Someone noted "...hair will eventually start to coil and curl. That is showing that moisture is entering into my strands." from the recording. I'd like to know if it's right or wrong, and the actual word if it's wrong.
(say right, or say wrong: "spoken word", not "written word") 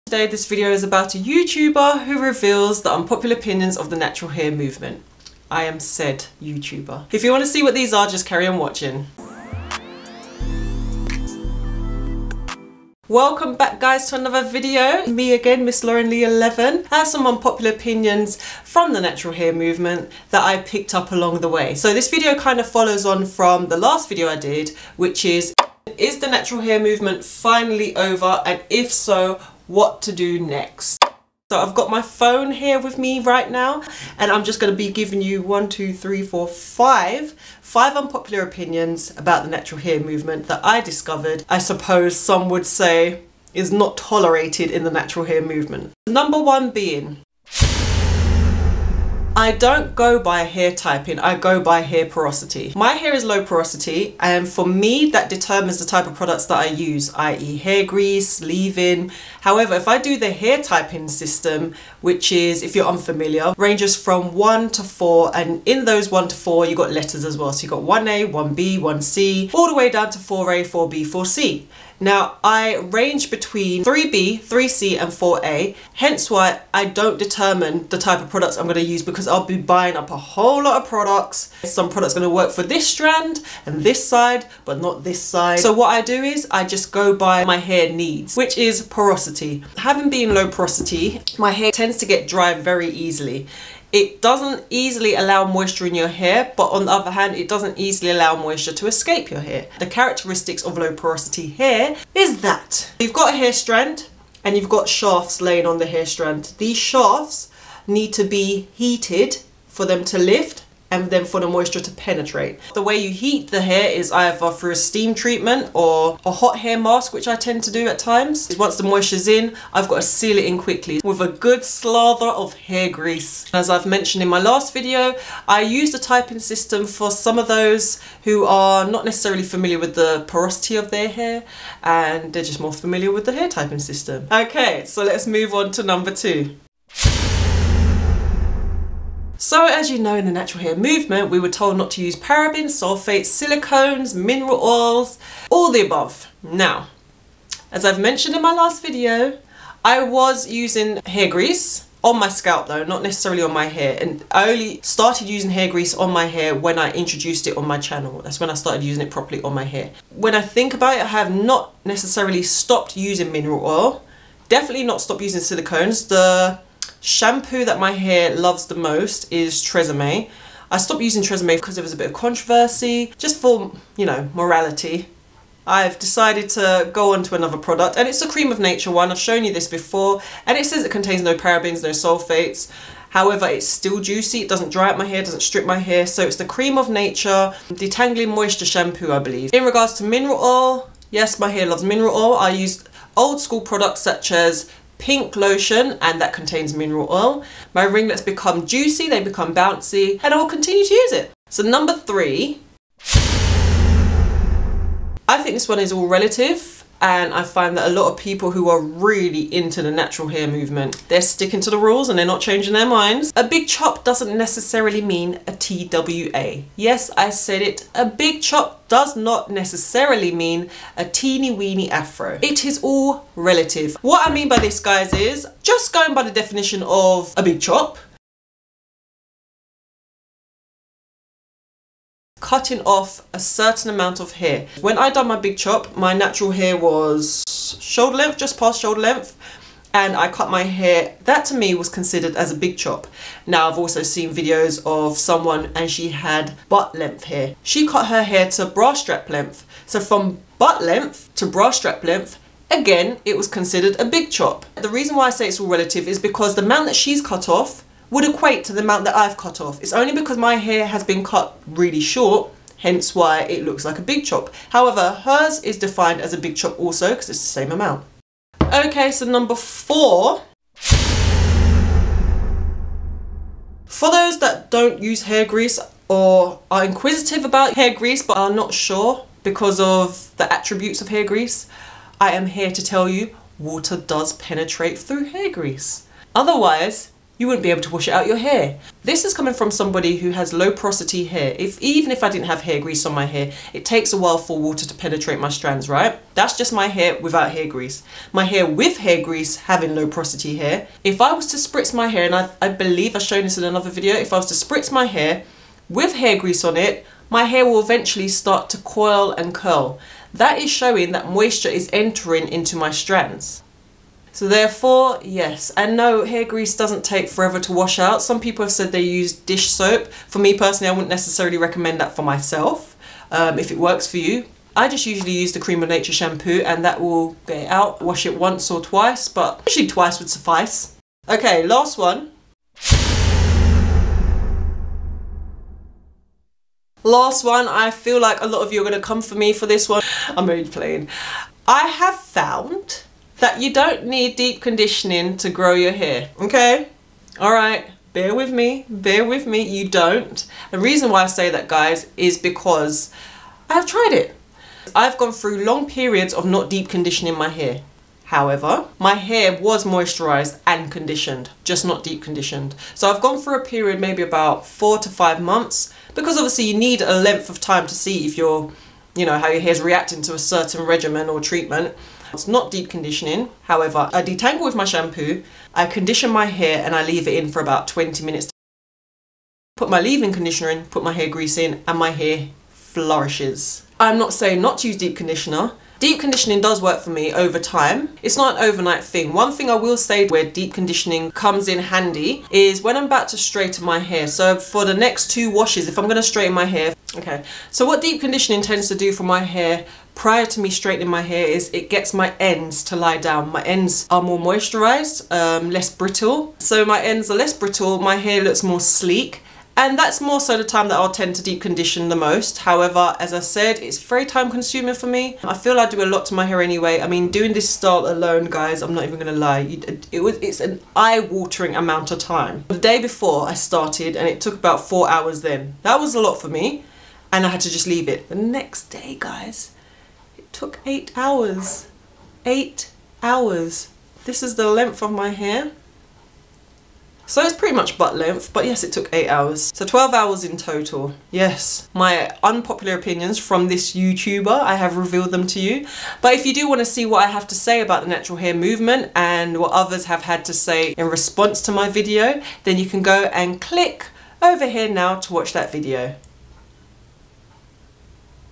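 right.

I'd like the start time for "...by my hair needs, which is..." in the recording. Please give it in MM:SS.
01:27.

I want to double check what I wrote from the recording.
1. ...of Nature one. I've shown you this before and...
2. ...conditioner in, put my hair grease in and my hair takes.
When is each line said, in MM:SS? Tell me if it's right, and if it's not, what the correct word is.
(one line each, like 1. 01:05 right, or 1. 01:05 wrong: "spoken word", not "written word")
1. 02:58 right
2. 06:20 wrong: "flourishes", not "takes".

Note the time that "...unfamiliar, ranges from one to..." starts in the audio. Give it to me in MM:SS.
01:02.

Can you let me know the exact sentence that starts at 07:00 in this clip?
It was, it's an eye-watering amount of time.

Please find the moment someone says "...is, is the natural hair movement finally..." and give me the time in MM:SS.
00:25.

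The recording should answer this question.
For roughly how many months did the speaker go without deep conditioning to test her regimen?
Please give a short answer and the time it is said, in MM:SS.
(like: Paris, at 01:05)
4 to 5 months, at 06:04.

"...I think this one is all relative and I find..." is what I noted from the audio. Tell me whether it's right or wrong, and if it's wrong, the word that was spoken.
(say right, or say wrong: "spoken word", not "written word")
right.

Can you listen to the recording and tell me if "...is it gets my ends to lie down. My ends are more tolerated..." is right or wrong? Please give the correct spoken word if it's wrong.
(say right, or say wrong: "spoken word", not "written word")
wrong: "moisturized", not "tolerated".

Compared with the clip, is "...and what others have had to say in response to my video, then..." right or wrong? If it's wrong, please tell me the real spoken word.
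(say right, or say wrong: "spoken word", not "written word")
right.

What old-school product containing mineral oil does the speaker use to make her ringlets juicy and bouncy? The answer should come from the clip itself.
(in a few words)
Pink lotion.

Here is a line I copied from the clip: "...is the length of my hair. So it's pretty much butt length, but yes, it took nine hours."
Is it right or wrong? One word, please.
wrong.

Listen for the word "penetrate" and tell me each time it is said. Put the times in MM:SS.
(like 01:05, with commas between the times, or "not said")
01:51, 04:44, 04:54.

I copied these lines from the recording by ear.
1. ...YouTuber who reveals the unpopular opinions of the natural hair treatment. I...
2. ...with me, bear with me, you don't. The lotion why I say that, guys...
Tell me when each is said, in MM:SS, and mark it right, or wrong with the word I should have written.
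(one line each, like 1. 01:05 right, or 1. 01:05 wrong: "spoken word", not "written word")
1. 00:01 wrong: "movement", not "treatment"
2. 05:48 wrong: "reason", not "lotion".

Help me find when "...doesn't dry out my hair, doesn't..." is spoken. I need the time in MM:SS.
03:04.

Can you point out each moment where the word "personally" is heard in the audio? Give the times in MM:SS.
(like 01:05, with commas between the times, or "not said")
05:20.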